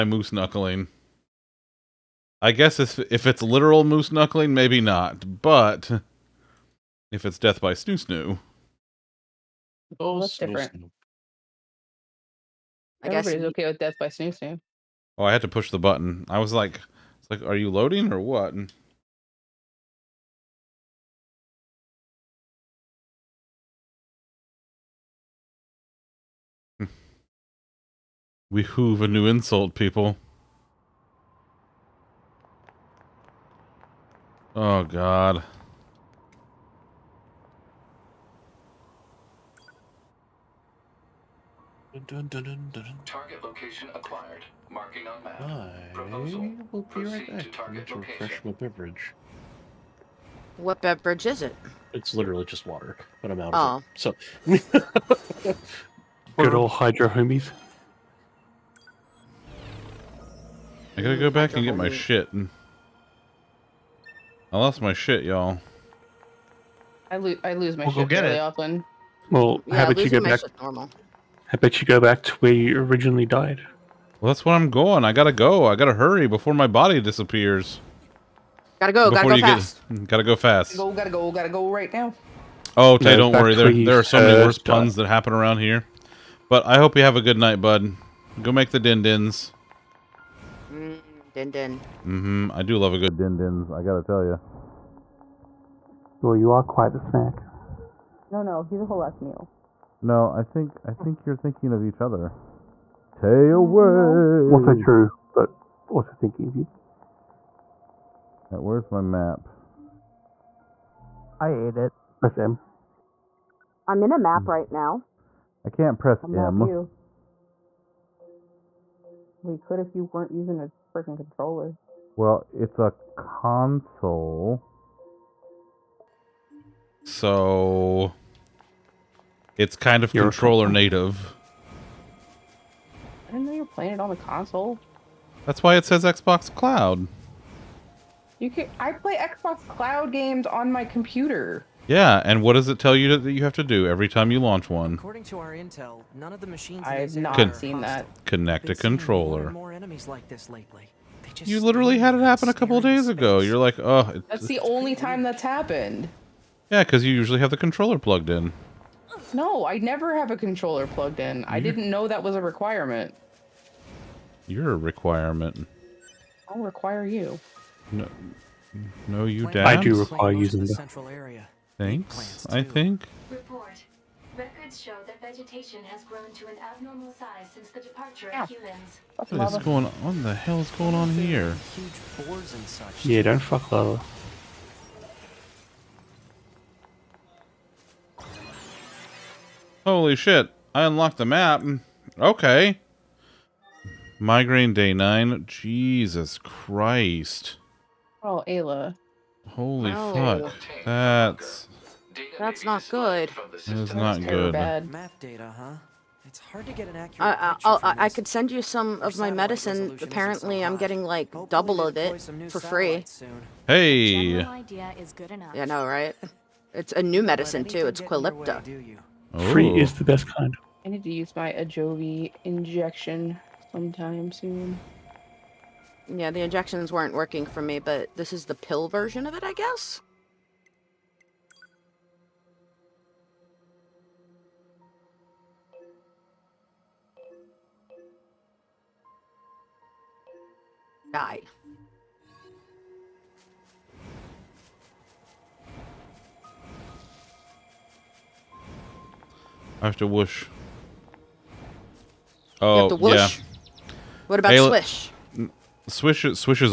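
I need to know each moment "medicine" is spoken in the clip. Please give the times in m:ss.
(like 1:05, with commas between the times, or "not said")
3:29, 3:37.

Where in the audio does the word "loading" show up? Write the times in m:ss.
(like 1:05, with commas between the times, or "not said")
0:17.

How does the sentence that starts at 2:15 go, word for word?
That's why it says Xbox Cloud.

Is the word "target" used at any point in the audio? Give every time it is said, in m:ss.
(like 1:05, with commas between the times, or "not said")
0:43, 0:47.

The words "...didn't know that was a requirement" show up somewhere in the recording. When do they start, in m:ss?
2:41.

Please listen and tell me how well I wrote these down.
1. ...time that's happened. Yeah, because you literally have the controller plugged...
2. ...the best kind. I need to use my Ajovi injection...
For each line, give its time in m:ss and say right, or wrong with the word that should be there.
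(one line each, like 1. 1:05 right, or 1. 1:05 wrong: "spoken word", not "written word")
1. 2:34 wrong: "usually", not "literally"
2. 3:39 right.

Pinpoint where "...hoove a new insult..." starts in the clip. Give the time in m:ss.
0:28.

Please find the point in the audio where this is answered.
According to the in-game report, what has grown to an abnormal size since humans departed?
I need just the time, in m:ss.
2:55.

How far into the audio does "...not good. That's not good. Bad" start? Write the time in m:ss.
3:22.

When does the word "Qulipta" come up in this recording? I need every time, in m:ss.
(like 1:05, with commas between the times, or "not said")
3:37.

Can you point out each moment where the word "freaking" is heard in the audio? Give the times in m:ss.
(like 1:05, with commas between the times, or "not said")
2:00.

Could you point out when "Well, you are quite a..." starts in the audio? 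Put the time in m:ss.
1:36.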